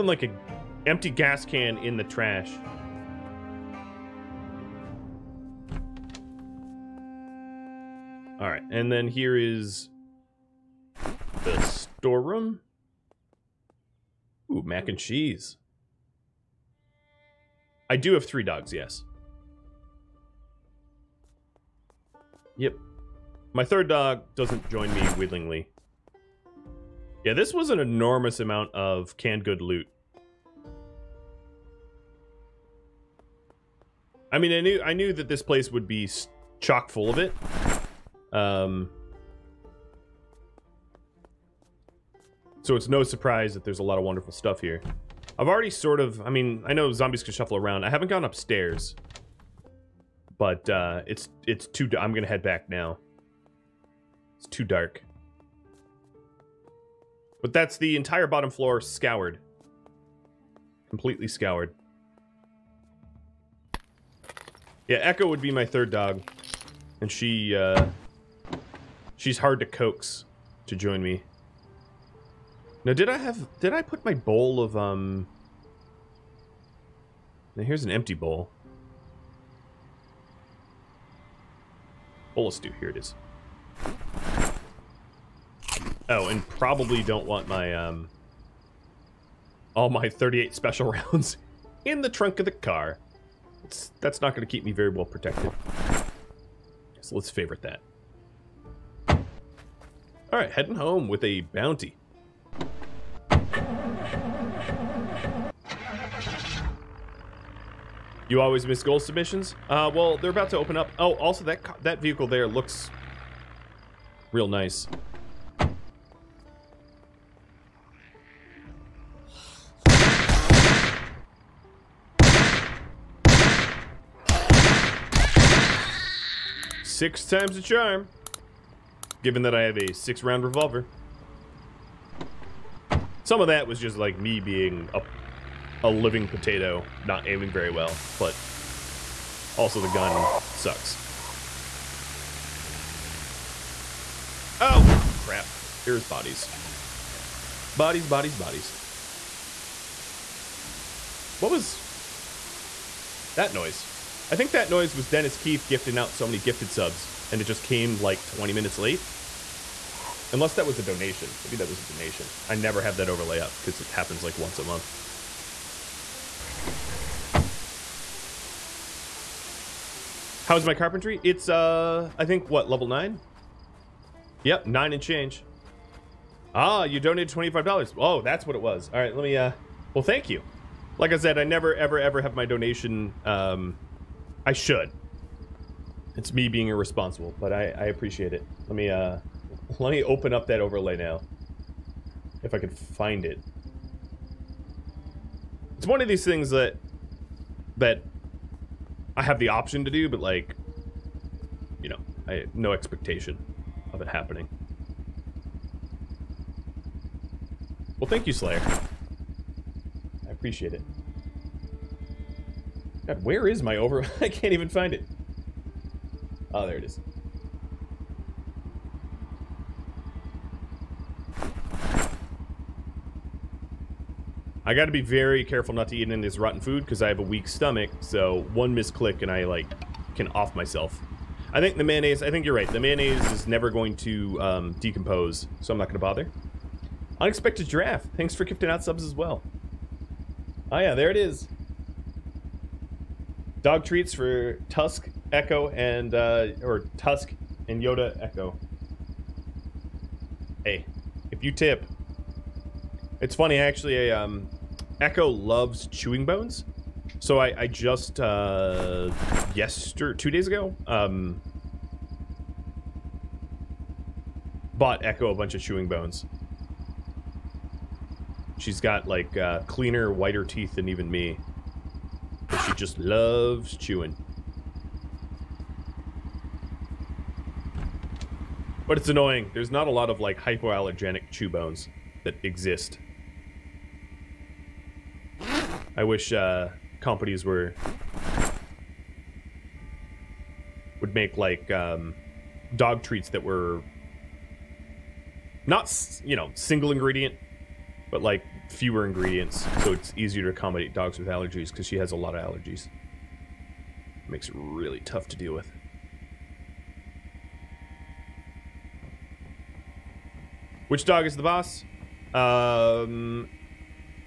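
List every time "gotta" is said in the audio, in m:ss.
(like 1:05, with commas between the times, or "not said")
3:44.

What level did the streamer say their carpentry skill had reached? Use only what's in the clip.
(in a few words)
9.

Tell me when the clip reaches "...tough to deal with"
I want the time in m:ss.
5:05.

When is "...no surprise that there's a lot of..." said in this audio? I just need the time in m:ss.
0:42.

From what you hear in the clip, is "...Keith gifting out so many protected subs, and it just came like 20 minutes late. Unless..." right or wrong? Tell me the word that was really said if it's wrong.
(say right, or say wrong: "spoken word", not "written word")
wrong: "gifted", not "protected".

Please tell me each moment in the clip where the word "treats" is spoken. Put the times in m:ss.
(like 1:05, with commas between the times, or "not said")
4:03, 4:53.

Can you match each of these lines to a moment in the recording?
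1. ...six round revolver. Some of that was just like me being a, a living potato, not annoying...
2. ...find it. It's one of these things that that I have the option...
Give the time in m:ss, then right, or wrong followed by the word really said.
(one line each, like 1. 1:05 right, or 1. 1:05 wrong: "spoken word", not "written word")
1. 2:09 wrong: "aiming", not "annoying"
2. 3:12 right.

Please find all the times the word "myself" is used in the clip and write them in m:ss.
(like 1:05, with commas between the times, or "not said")
3:50.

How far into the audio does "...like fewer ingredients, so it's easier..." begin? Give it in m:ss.
4:58.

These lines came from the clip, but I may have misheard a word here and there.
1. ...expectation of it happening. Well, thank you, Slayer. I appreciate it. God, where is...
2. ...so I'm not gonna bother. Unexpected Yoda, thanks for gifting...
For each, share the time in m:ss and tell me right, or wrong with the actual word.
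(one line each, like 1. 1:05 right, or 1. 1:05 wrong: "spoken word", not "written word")
1. 3:22 right
2. 3:55 wrong: "Giraffe", not "Yoda".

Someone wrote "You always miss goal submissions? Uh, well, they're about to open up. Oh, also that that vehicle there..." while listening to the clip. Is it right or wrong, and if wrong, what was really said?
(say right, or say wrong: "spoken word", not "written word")
right.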